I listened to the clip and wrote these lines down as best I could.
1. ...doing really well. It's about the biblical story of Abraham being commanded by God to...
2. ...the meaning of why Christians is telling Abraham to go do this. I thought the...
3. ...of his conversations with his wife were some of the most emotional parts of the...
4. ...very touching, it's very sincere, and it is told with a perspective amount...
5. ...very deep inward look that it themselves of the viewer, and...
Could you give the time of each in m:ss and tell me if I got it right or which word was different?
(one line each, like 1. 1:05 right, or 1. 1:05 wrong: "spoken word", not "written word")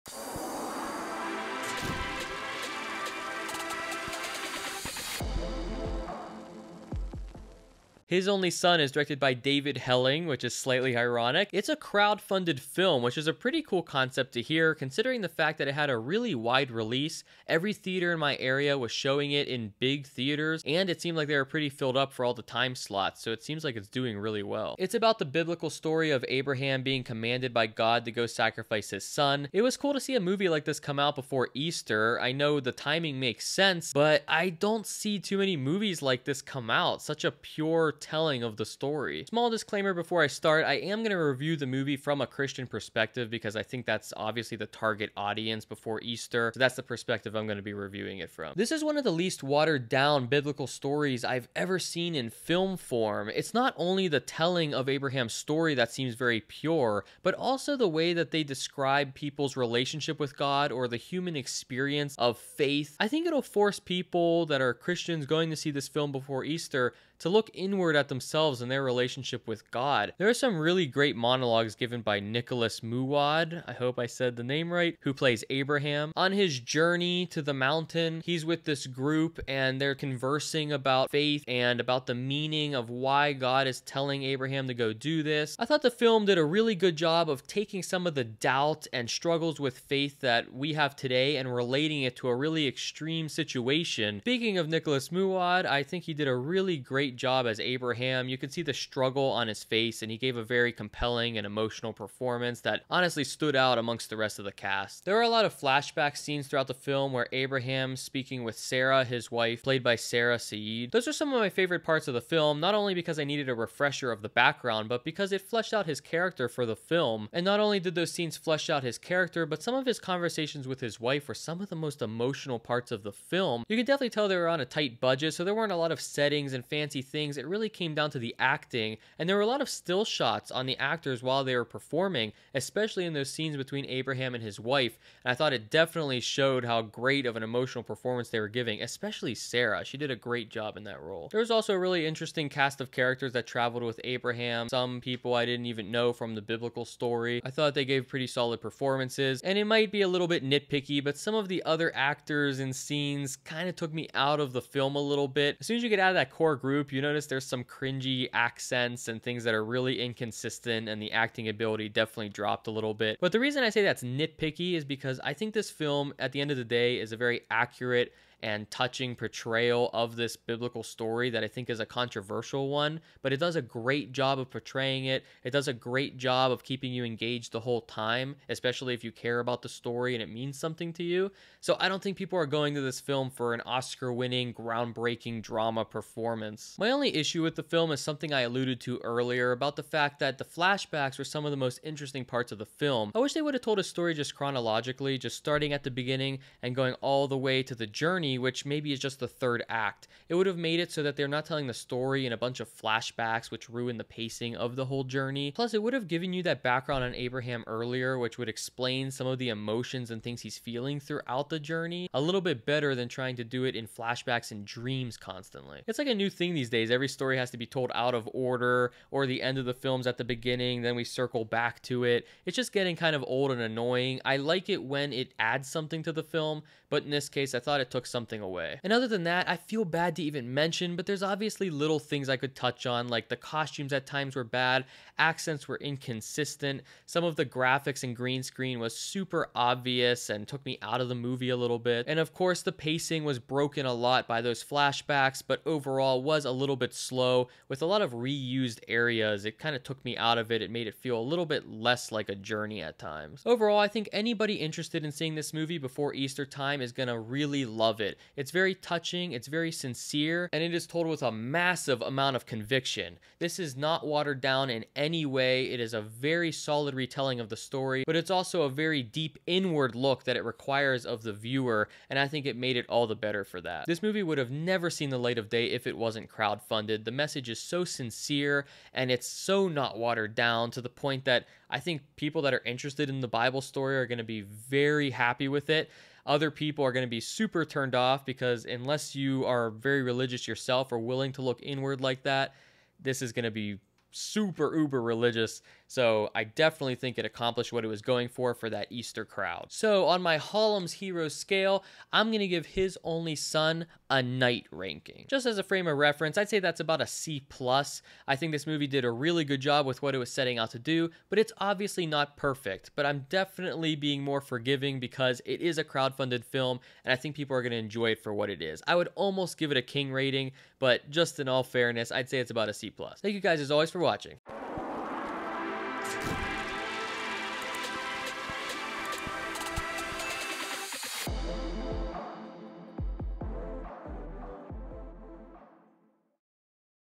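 1. 0:23 right
2. 1:22 wrong: "God", not "Christians"
3. 1:59 right
4. 4:18 wrong: "massive", not "perspective"
5. 4:28 wrong: "requires", not "themselves".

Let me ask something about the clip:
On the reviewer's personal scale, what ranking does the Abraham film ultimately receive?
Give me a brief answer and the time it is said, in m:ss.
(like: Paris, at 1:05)
knight, at 5:04.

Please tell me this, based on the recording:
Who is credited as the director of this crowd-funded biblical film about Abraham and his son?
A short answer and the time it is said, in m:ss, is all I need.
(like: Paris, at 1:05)
David Helling, at 0:09.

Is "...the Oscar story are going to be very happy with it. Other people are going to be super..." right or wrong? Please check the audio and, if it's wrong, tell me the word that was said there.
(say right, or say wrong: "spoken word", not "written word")
wrong: "Bible", not "Oscar".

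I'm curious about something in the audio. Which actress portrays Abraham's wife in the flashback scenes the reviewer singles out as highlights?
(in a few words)
Sarah Saeed.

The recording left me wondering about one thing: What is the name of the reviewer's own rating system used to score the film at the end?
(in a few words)
Halum's Hero scale.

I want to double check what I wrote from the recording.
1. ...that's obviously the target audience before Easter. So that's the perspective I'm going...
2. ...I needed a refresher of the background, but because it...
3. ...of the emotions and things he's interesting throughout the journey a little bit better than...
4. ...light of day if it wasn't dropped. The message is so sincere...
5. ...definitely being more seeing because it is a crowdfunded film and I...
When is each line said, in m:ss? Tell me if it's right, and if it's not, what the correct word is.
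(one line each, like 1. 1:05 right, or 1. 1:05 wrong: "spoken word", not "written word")
1. 0:43 right
2. 1:53 right
3. 3:29 wrong: "feeling", not "interesting"
4. 4:35 wrong: "crowdfunded", not "dropped"
5. 5:13 wrong: "forgiving", not "seeing".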